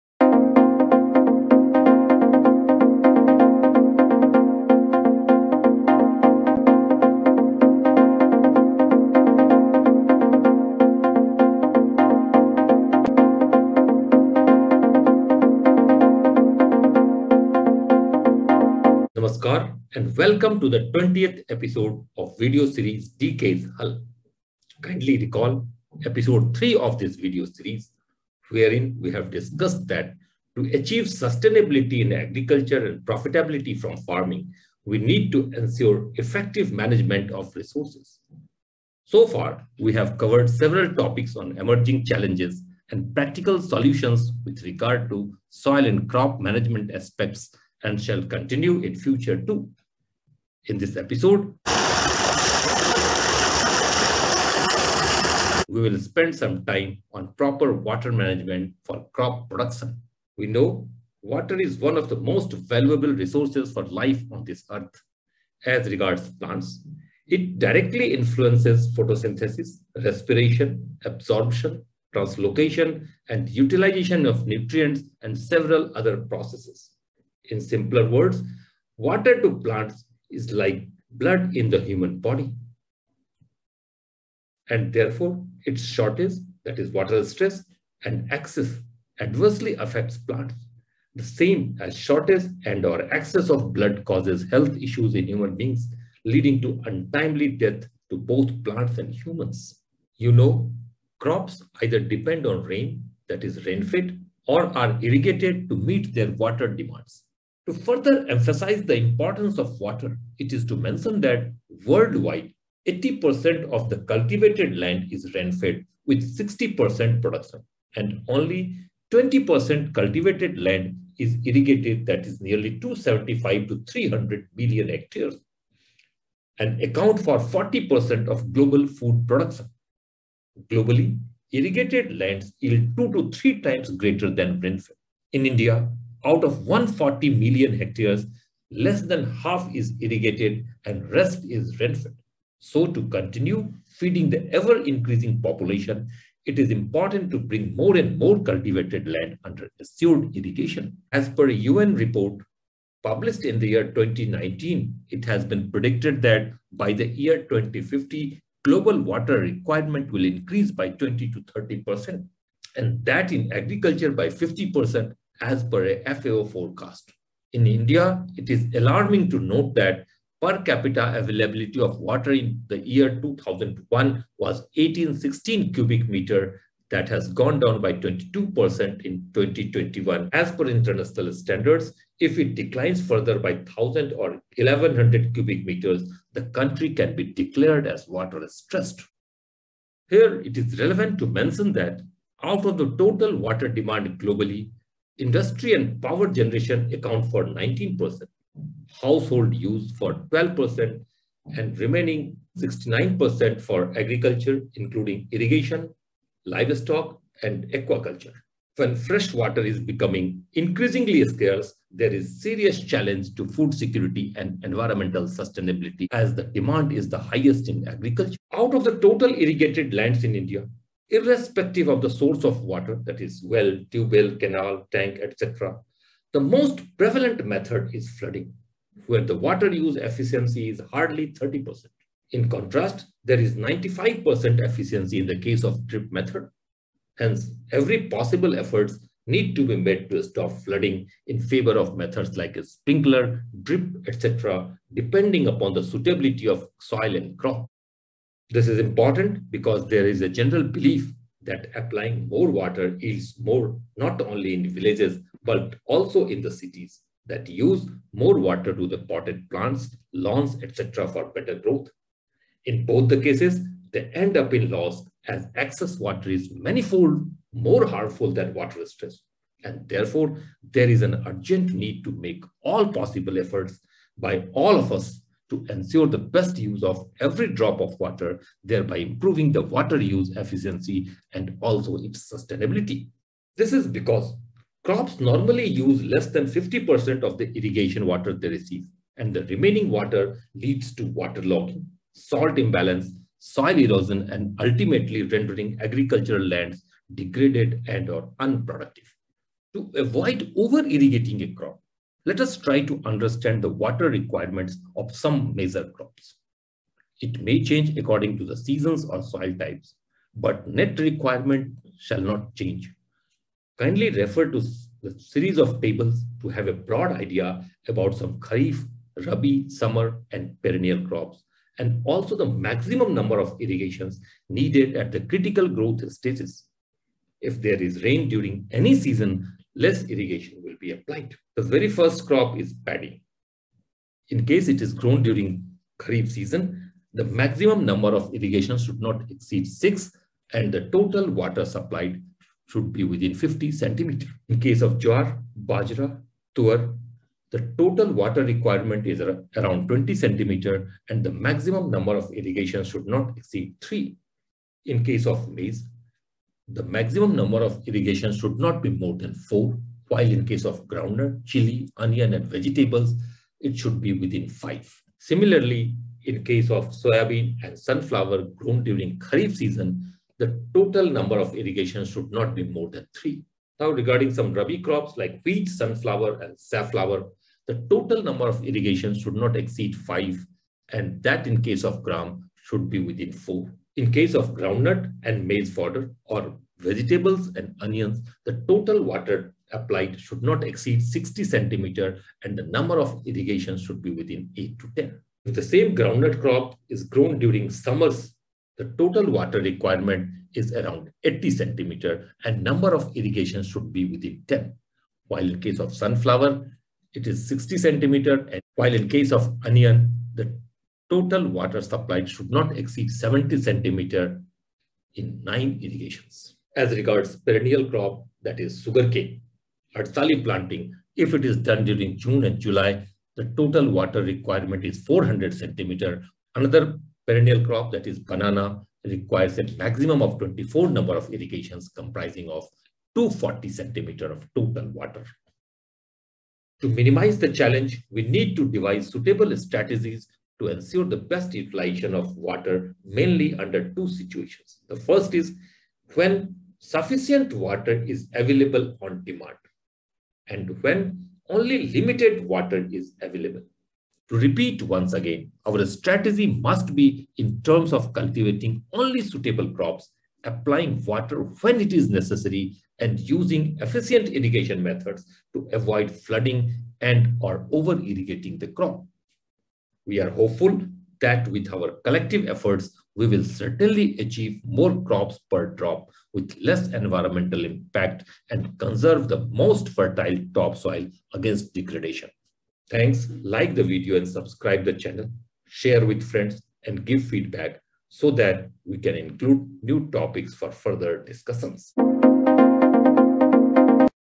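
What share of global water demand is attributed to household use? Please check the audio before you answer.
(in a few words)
12%.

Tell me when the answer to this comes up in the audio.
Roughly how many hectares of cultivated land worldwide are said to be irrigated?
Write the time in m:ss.
2:02.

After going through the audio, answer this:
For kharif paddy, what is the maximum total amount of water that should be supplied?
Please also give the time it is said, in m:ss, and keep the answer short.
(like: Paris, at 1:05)
50 centimeters, at 5:43.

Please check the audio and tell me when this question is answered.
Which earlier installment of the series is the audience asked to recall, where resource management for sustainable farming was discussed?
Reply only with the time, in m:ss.
0:26.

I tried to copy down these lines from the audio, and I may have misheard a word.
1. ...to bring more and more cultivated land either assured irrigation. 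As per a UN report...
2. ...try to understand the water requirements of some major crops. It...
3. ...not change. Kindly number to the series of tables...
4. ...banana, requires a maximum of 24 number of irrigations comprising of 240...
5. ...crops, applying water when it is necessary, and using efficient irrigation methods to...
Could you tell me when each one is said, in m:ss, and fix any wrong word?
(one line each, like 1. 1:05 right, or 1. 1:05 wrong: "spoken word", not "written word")
1. 2:27 wrong: "under", not "either"
2. 5:02 right
3. 5:12 wrong: "refer", not "number"
4. 7:08 right
5. 7:39 right.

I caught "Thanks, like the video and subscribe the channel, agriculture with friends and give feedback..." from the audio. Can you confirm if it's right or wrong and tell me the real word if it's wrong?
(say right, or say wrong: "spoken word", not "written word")
wrong: "share", not "agriculture".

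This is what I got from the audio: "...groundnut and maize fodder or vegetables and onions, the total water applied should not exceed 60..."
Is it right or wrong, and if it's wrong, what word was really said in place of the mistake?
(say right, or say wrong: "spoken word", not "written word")
right.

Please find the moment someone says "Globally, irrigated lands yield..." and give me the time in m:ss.
2:10.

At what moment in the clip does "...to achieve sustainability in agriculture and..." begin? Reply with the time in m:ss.
0:30.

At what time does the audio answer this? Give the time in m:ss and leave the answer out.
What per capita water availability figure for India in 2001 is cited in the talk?
2:54.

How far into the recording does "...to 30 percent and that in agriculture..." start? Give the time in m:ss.
2:41.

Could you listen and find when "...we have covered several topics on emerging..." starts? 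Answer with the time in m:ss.
0:39.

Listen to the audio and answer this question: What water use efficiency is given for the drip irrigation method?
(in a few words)
95%.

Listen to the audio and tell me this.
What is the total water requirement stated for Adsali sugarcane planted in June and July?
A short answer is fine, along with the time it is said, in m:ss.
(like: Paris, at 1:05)
400 centimeters, at 7:05.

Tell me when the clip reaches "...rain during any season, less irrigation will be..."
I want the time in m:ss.
5:28.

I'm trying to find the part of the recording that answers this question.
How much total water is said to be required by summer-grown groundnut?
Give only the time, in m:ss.
6:41.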